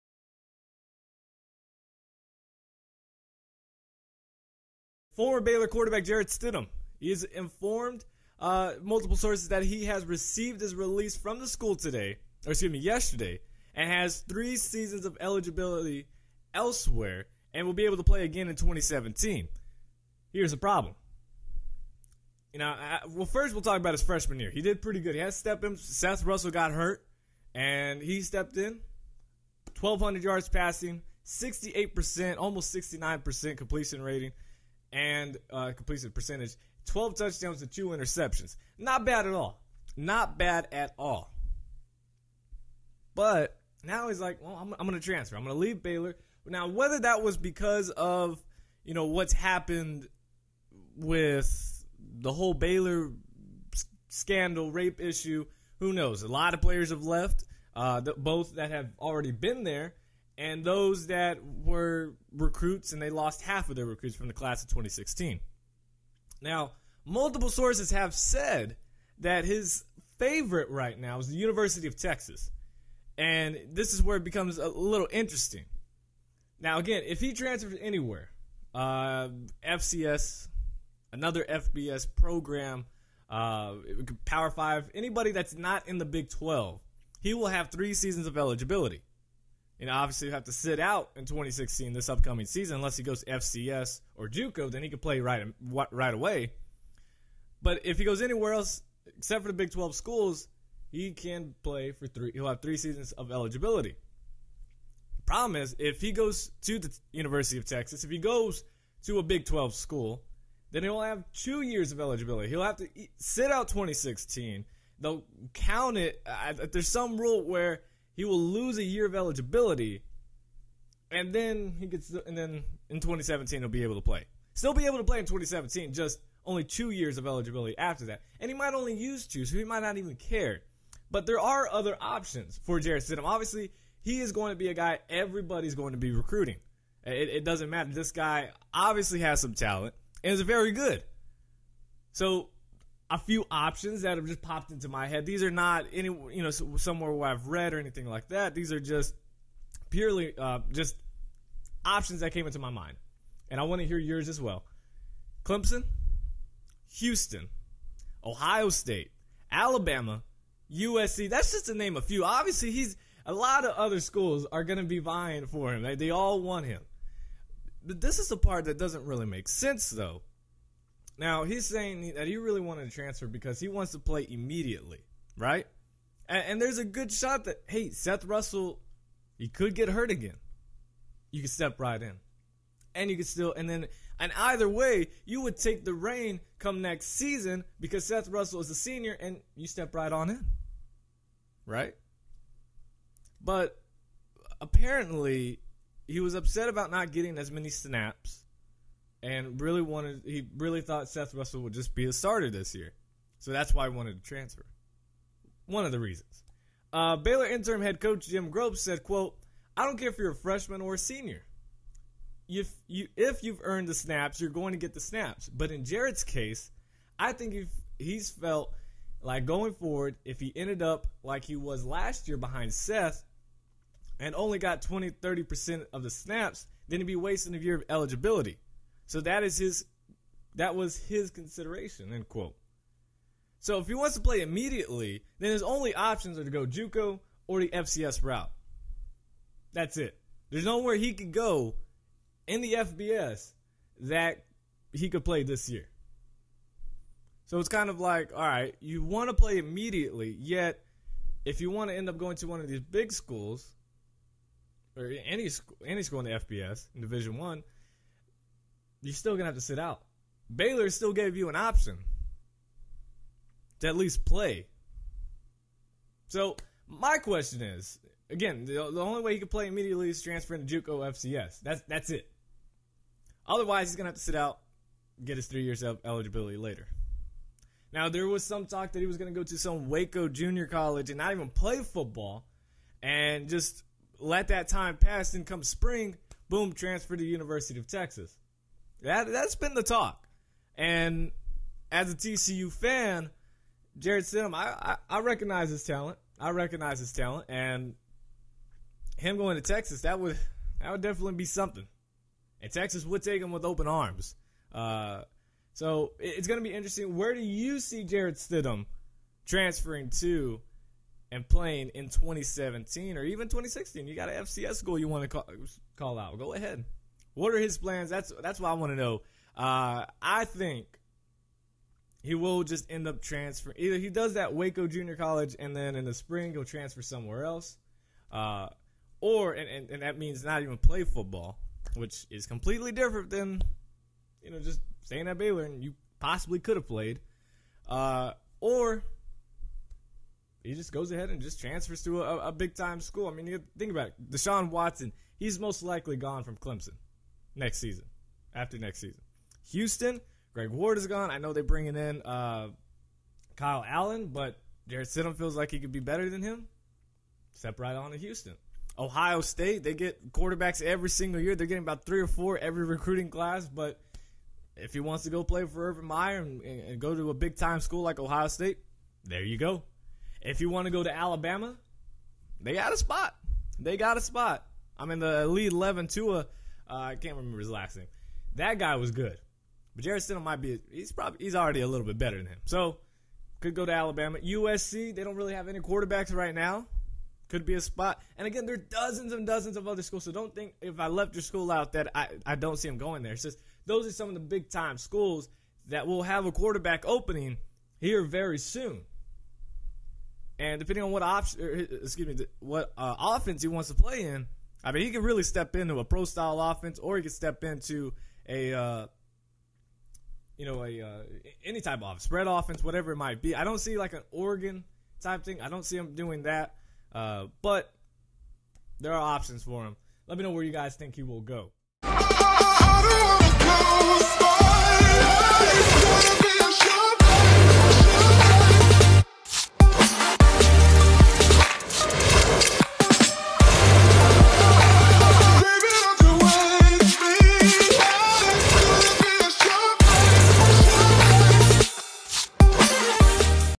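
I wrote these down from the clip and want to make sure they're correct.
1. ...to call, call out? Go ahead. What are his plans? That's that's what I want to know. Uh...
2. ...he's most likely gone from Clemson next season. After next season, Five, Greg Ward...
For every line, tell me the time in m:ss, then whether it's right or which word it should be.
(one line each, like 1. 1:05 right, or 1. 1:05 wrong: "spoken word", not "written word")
1. 5:15 right
2. 5:45 wrong: "Houston", not "Five".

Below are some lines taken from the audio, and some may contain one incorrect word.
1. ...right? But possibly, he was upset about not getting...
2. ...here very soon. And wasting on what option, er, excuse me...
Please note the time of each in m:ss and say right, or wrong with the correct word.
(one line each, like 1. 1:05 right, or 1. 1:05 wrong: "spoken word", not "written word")
1. 3:11 wrong: "apparently", not "possibly"
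2. 6:38 wrong: "depending", not "wasting".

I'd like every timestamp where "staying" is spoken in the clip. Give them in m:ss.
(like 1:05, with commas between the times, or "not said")
5:35.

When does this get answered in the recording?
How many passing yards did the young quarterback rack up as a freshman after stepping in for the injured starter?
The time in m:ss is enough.
0:29.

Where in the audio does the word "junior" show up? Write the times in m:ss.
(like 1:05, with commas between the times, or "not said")
4:40, 5:24.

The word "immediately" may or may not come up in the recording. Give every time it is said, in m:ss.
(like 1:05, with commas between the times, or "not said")
2:54, 3:54, 4:09, 4:29.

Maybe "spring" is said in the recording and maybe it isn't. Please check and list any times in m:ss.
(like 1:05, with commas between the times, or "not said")
4:45, 5:26.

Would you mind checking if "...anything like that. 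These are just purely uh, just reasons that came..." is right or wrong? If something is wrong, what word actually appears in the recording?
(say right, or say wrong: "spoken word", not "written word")
wrong: "options", not "reasons".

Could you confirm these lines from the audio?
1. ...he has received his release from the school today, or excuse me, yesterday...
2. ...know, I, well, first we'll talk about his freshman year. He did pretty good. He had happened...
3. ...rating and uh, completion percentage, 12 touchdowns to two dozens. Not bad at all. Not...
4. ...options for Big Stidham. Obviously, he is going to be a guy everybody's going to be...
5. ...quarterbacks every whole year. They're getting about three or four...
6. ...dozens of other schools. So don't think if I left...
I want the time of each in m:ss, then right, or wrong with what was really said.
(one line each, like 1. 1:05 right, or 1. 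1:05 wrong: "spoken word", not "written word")
1. 0:09 right
2. 0:22 wrong: "stepped", not "happened"
3. 0:34 wrong: "interceptions", not "dozens"
4. 2:11 wrong: "Jarrett", not "Big"
5. 6:00 wrong: "single", not "whole"
6. 6:29 right.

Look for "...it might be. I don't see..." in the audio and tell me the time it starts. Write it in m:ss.
6:53.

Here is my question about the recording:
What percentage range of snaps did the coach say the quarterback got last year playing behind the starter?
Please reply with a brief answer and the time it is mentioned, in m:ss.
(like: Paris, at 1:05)
20-30%, at 3:44.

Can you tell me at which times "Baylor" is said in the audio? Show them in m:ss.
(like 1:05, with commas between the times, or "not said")
0:05, 0:45, 0:52, 3:27, 4:20, 5:35.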